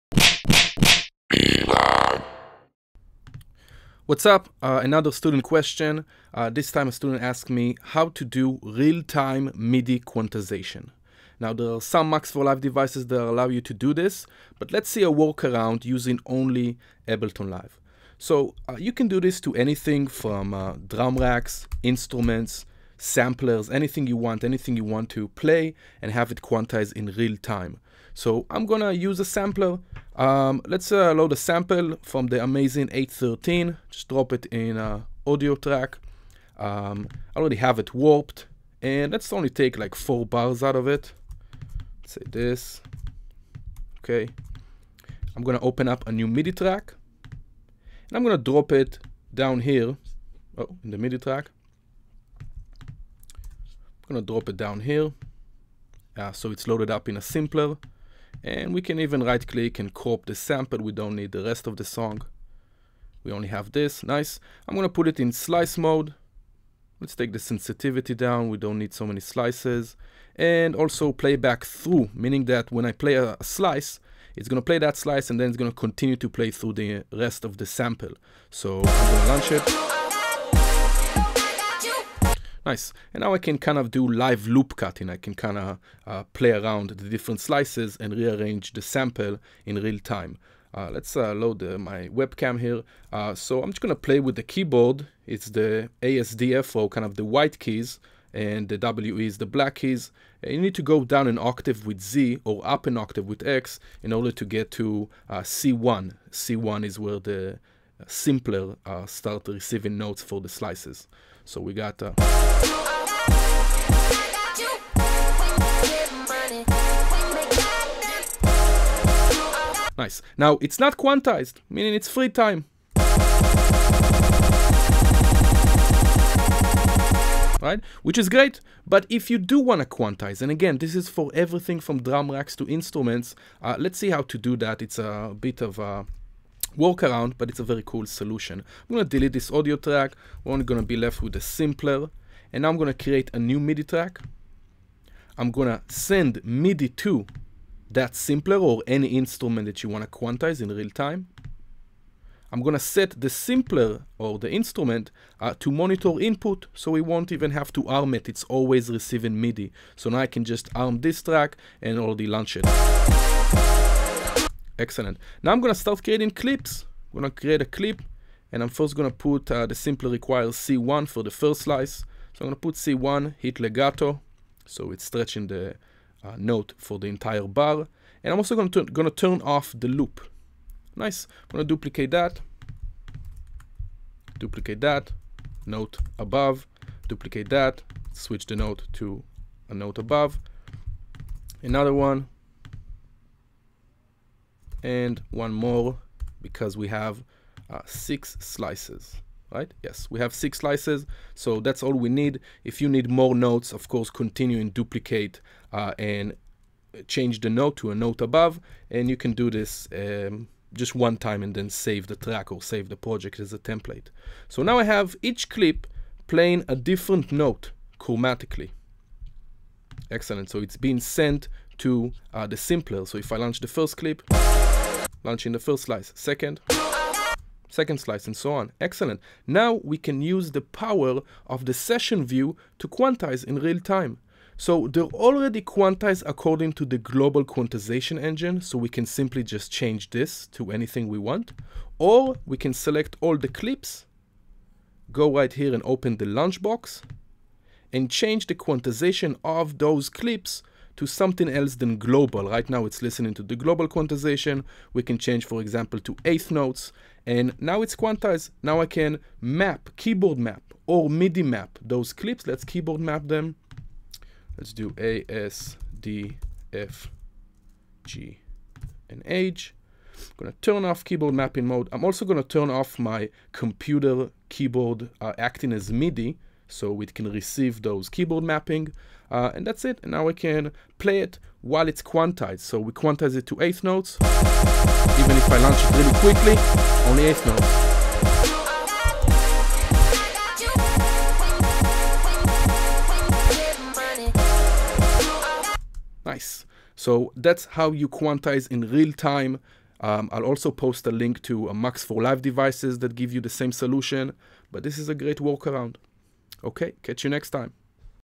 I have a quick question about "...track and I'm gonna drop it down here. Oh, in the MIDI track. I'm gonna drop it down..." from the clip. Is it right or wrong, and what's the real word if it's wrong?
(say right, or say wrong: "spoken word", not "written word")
right.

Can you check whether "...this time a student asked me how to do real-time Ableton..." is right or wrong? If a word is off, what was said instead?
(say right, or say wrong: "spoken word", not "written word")
wrong: "MIDI", not "Ableton".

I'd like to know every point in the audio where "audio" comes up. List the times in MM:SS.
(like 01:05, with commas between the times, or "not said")
00:35, 02:19.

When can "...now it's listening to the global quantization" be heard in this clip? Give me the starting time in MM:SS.
04:12.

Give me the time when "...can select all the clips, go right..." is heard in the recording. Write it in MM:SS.
04:02.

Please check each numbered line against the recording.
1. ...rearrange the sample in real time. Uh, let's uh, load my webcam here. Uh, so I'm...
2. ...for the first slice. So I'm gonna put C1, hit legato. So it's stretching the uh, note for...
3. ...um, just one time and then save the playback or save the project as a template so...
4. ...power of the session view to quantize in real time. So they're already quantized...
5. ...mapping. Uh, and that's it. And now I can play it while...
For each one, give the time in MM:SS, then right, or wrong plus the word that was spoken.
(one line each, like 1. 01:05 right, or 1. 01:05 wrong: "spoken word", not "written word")
1. 01:28 right
2. 02:51 right
3. 03:29 wrong: "track", not "playback"
4. 03:50 right
5. 04:38 right.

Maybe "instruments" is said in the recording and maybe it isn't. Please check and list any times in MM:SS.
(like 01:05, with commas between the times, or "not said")
00:21, 02:12, 02:29, 02:34.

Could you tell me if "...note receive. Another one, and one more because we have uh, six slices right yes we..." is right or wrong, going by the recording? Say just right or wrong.
wrong.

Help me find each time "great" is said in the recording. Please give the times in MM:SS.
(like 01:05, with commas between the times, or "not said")
02:08, 05:05.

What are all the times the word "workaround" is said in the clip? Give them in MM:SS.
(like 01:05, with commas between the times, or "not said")
00:15, 02:16, 05:05.